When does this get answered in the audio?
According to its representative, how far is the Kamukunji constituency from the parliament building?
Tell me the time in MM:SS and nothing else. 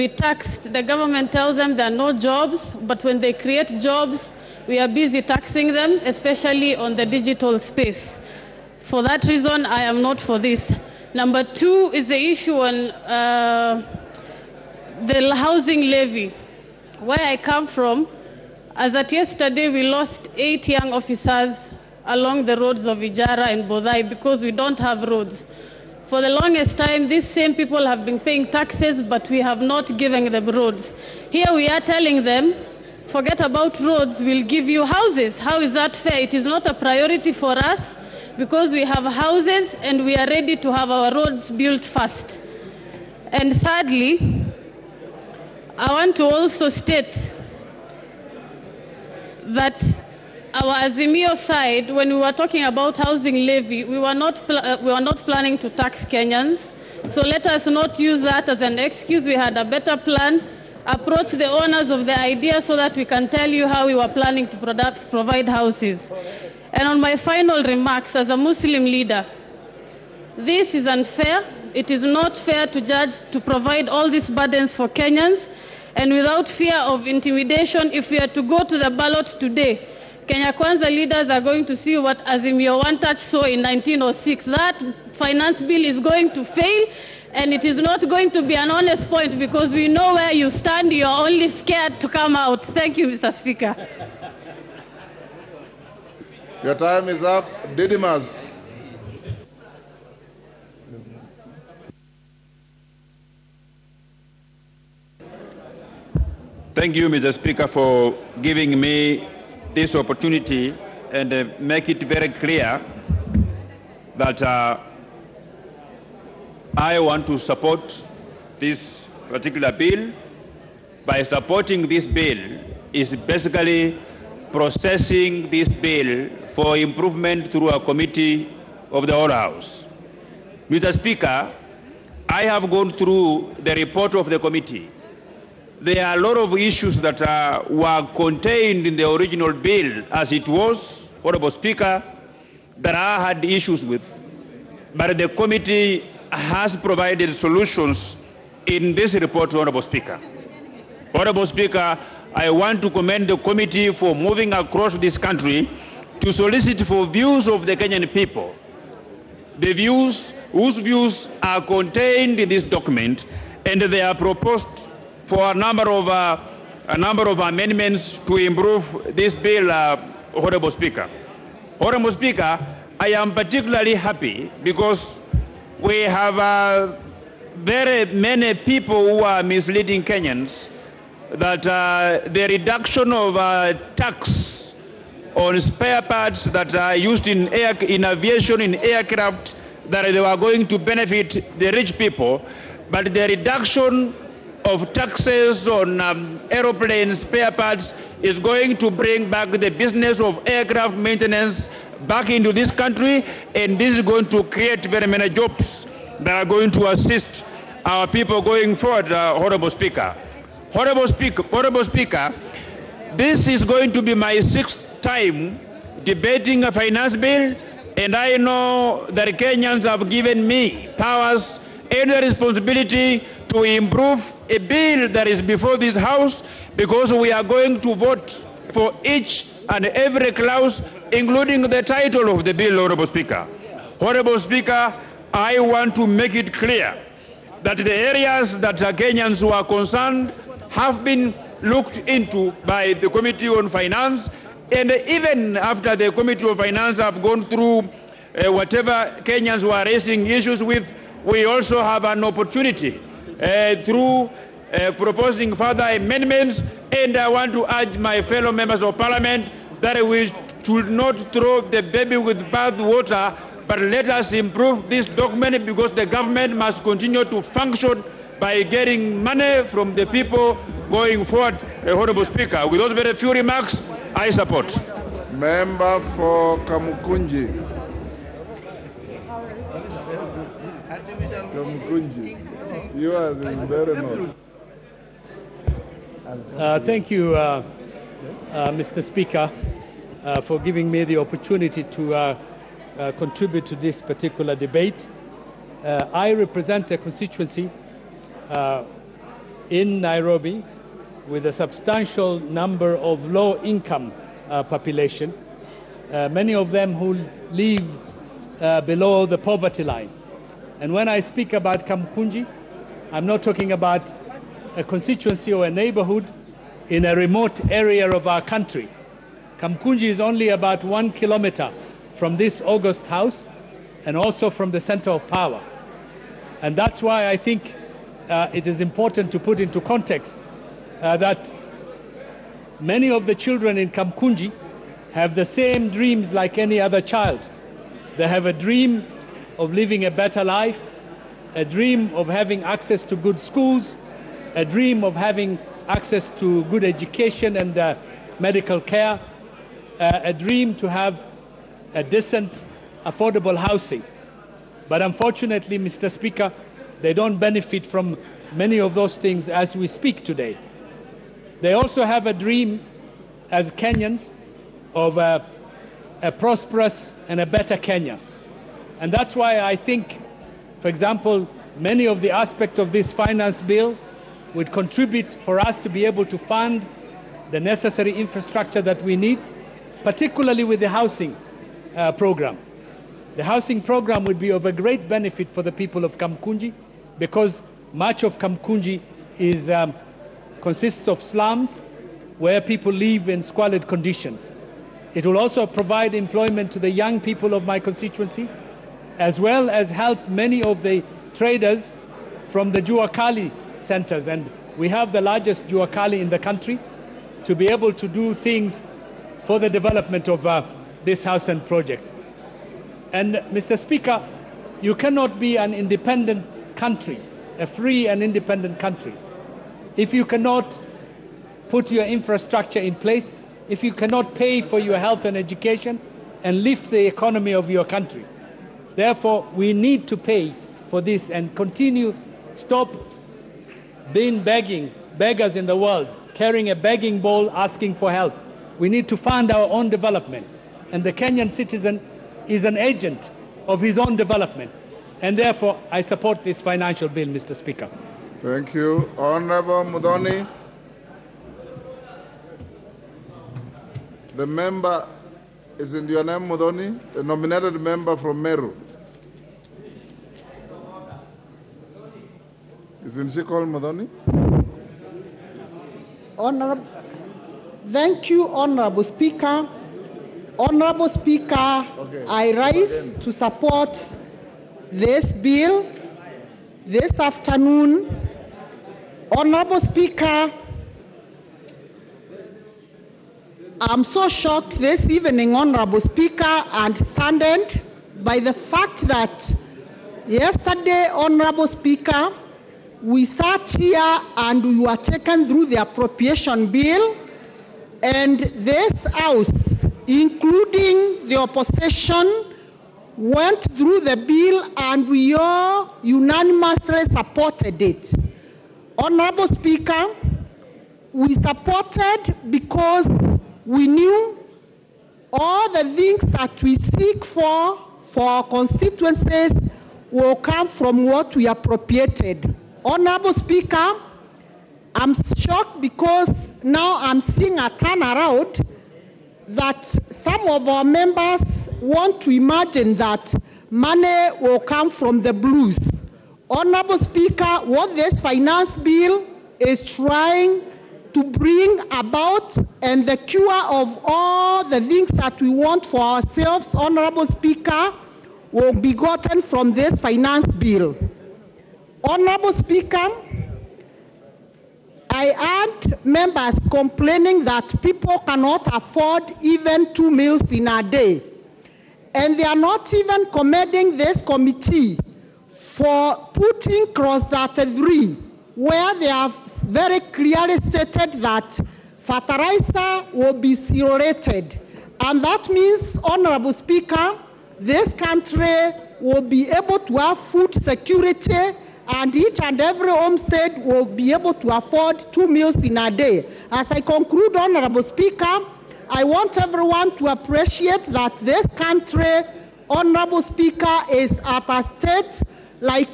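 05:20.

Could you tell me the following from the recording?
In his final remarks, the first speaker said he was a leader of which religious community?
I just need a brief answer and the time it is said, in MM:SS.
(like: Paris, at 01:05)
Muslim, at 01:08.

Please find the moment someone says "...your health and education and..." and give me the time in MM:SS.
07:04.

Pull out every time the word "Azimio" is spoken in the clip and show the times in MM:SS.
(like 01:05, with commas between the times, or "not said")
00:50, 01:22.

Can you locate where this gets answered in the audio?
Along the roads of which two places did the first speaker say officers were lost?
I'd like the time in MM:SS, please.
00:22.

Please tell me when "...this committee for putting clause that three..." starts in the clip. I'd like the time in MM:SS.
09:23.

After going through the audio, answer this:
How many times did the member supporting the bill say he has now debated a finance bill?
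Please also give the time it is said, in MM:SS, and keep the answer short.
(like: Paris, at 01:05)
6, at 03:34.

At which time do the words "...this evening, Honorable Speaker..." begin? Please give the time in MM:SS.
08:04.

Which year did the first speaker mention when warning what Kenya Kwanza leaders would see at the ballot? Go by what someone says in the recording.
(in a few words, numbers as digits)
1906.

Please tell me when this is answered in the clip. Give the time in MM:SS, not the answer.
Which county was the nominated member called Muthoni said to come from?
07:38.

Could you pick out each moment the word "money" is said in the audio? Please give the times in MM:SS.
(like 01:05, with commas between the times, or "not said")
04:29, 08:53.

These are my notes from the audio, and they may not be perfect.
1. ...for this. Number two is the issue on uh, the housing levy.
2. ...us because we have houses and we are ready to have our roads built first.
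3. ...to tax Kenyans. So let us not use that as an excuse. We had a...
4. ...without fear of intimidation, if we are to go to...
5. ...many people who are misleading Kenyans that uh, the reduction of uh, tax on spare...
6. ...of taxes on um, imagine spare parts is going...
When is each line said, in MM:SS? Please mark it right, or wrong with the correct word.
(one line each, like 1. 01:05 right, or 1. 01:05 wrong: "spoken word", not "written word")
1. 00:10 right
2. 00:37 right
3. 00:55 right
4. 01:16 right
5. 02:58 right
6. 03:14 wrong: "aeroplane", not "imagine".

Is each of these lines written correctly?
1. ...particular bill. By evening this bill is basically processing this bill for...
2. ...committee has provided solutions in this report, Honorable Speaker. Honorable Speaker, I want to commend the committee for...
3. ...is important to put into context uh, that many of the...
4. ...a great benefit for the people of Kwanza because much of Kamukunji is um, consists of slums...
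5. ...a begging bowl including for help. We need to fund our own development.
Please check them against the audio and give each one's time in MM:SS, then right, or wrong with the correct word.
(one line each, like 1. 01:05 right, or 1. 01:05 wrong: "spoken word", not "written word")
1. 01:59 wrong: "supporting", not "evening"
2. 02:25 right
3. 05:28 right
4. 06:24 wrong: "Kamukunji", not "Kwanza"
5. 07:16 wrong: "asking", not "including".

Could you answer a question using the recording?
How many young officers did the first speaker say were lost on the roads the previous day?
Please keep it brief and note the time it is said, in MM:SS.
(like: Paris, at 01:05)
8, at 00:20.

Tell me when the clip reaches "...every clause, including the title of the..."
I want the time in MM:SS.
03:49.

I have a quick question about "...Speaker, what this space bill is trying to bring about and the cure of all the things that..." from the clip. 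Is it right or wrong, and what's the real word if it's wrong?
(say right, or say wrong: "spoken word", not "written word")
wrong: "finance", not "space".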